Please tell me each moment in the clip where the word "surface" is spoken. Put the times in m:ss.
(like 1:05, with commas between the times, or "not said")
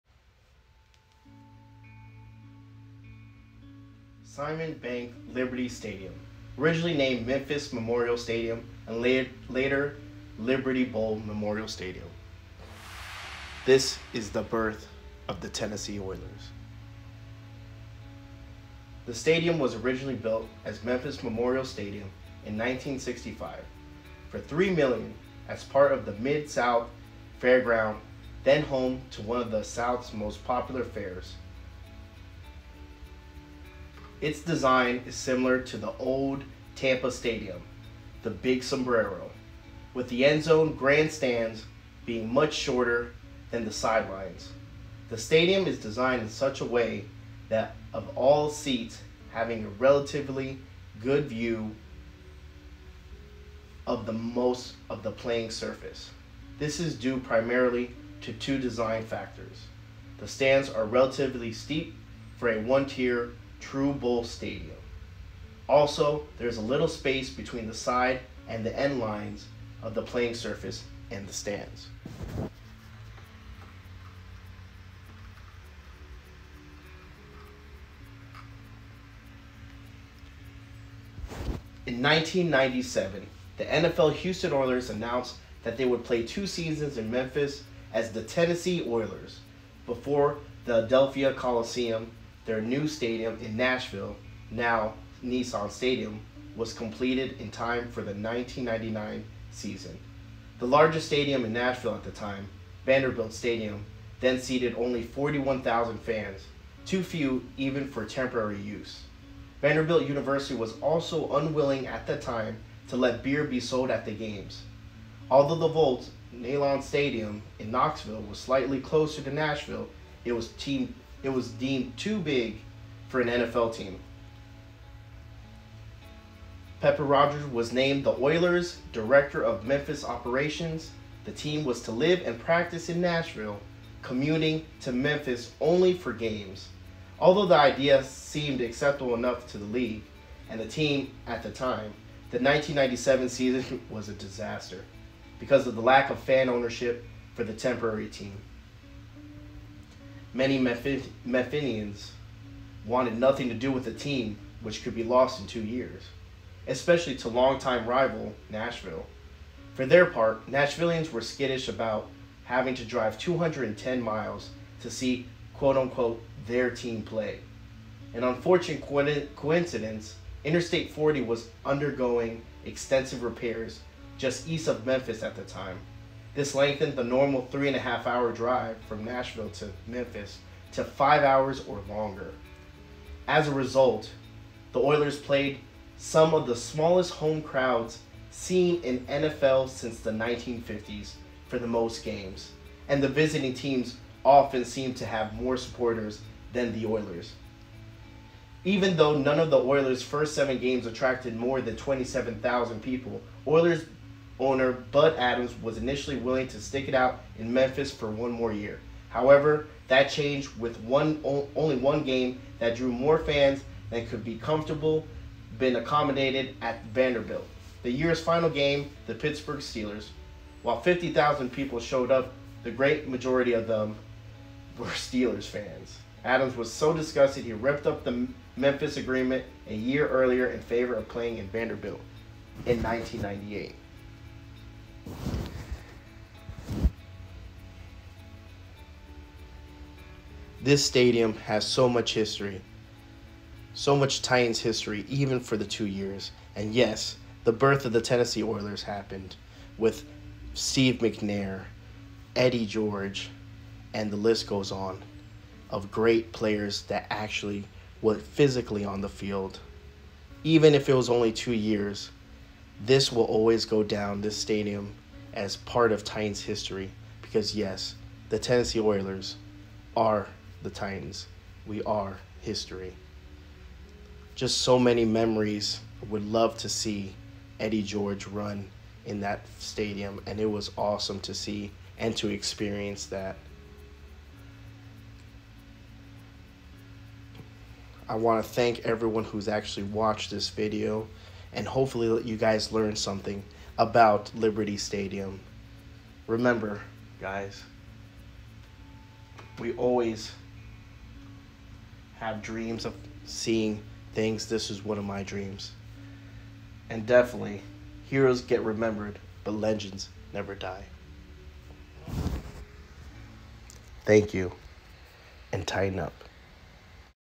0:55, 1:10.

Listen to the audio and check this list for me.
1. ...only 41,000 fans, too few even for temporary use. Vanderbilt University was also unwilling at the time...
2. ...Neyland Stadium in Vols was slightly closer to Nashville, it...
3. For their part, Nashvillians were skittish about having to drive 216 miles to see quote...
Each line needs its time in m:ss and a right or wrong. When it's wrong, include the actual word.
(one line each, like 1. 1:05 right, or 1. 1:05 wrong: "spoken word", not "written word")
1. 1:44 right
2. 1:56 wrong: "Knoxville", not "Vols"
3. 2:39 wrong: "210", not "216".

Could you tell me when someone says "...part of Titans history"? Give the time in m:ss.
4:25.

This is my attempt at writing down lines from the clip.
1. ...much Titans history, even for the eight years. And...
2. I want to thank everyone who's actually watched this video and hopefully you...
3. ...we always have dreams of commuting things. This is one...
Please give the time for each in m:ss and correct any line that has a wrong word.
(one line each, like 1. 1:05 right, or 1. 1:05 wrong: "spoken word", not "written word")
1. 4:03 wrong: "two", not "eight"
2. 4:48 right
3. 4:59 wrong: "seeing", not "commuting".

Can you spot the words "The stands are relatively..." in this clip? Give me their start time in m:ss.
1:00.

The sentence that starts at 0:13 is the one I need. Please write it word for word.
This is the birth of the Tennessee Oilers.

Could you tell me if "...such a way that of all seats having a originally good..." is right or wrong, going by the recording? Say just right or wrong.
wrong.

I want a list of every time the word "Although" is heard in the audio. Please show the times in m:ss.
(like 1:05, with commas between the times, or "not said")
1:55, 2:17.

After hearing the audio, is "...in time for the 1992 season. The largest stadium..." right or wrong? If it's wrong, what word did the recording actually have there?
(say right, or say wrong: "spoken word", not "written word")
wrong: "1999", not "1992".